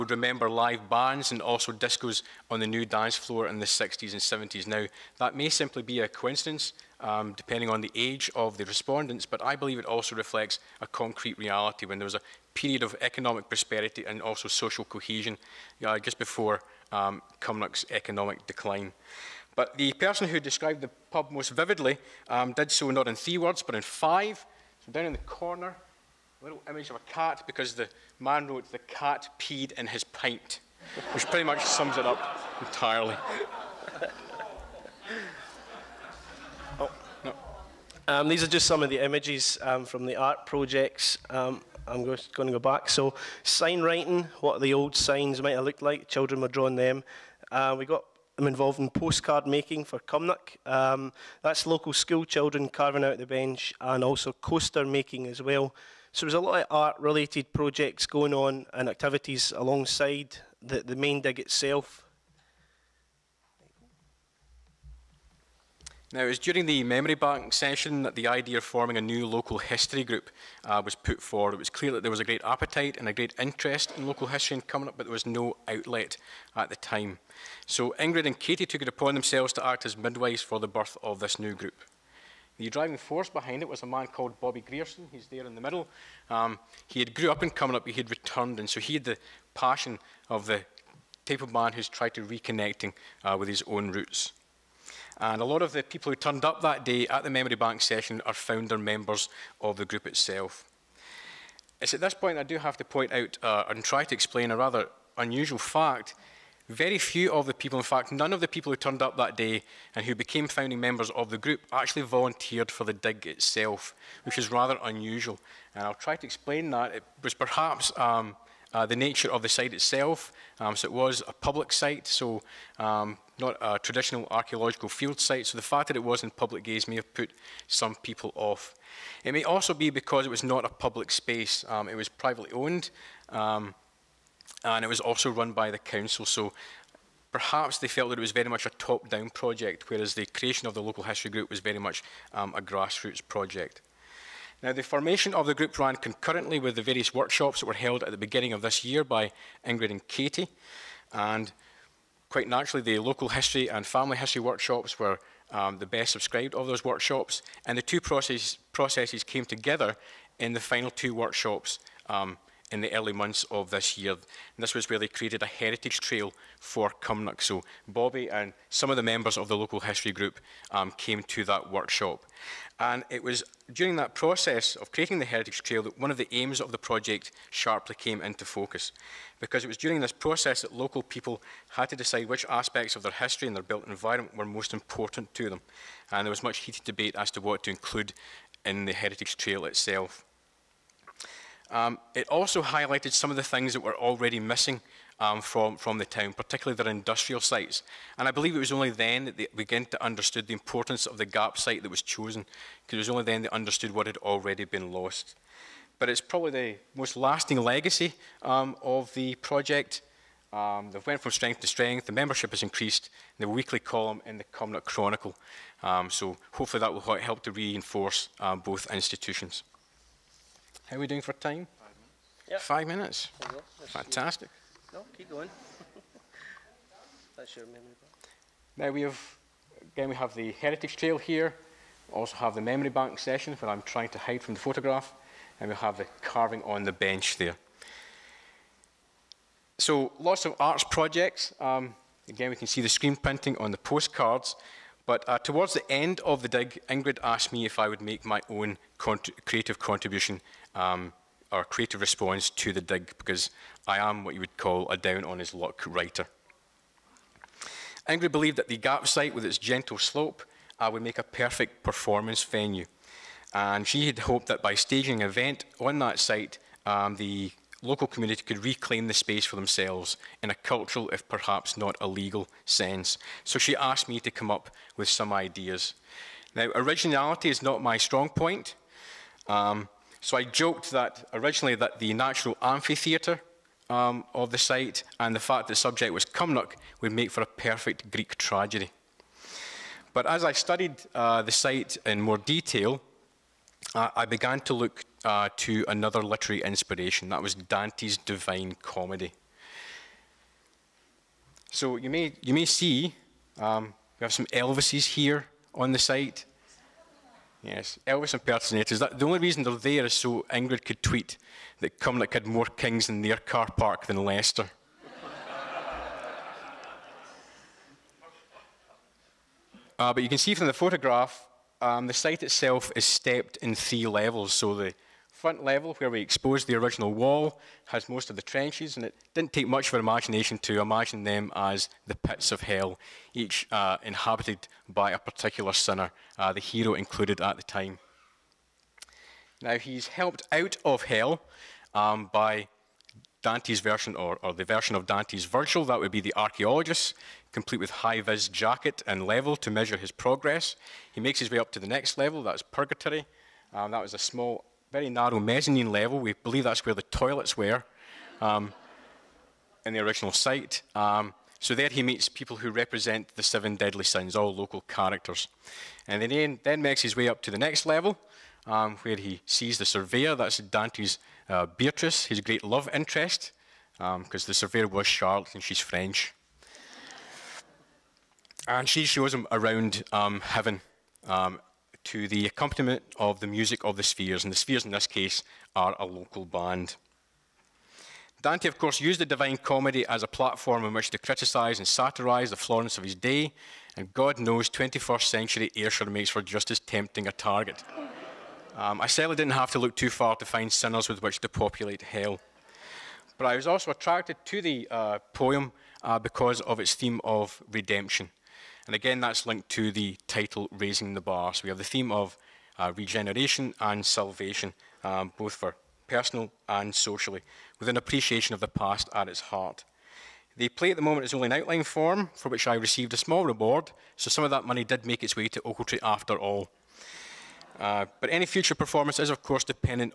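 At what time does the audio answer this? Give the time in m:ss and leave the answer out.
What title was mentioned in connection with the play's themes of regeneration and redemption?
6:50.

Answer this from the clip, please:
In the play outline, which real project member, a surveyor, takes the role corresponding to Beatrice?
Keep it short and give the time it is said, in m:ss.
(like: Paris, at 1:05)
Charlotte, at 6:15.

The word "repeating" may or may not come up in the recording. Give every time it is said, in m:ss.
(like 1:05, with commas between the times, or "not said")
not said.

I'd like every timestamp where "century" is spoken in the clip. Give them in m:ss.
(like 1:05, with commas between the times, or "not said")
6:35.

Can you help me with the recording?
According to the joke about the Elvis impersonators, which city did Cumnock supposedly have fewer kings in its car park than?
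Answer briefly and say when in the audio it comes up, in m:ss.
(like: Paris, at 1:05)
Leicester, at 5:14.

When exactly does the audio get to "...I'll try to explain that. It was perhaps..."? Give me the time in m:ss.
1:55.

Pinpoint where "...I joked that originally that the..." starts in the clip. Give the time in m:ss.
4:40.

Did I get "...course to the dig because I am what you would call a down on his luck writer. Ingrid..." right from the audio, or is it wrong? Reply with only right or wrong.
wrong.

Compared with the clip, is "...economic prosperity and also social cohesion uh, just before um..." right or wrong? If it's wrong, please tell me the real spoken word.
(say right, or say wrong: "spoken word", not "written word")
right.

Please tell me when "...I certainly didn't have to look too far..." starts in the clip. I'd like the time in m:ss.
6:39.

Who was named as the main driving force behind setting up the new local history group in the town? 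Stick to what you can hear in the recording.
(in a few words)
Bobby Grierson.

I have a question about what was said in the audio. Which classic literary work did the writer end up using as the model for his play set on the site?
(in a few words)
Dante's Divine Comedy.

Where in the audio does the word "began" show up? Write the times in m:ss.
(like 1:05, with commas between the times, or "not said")
3:19, 4:54.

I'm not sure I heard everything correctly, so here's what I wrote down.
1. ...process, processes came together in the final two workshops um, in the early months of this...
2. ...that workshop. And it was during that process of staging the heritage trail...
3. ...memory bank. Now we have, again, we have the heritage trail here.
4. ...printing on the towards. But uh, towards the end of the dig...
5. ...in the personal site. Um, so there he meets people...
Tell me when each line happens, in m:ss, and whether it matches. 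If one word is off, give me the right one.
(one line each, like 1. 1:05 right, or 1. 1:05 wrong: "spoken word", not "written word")
1. 2:38 right
2. 2:51 wrong: "creating", not "staging"
3. 3:47 right
4. 4:03 wrong: "postcards", not "towards"
5. 5:59 wrong: "original", not "personal".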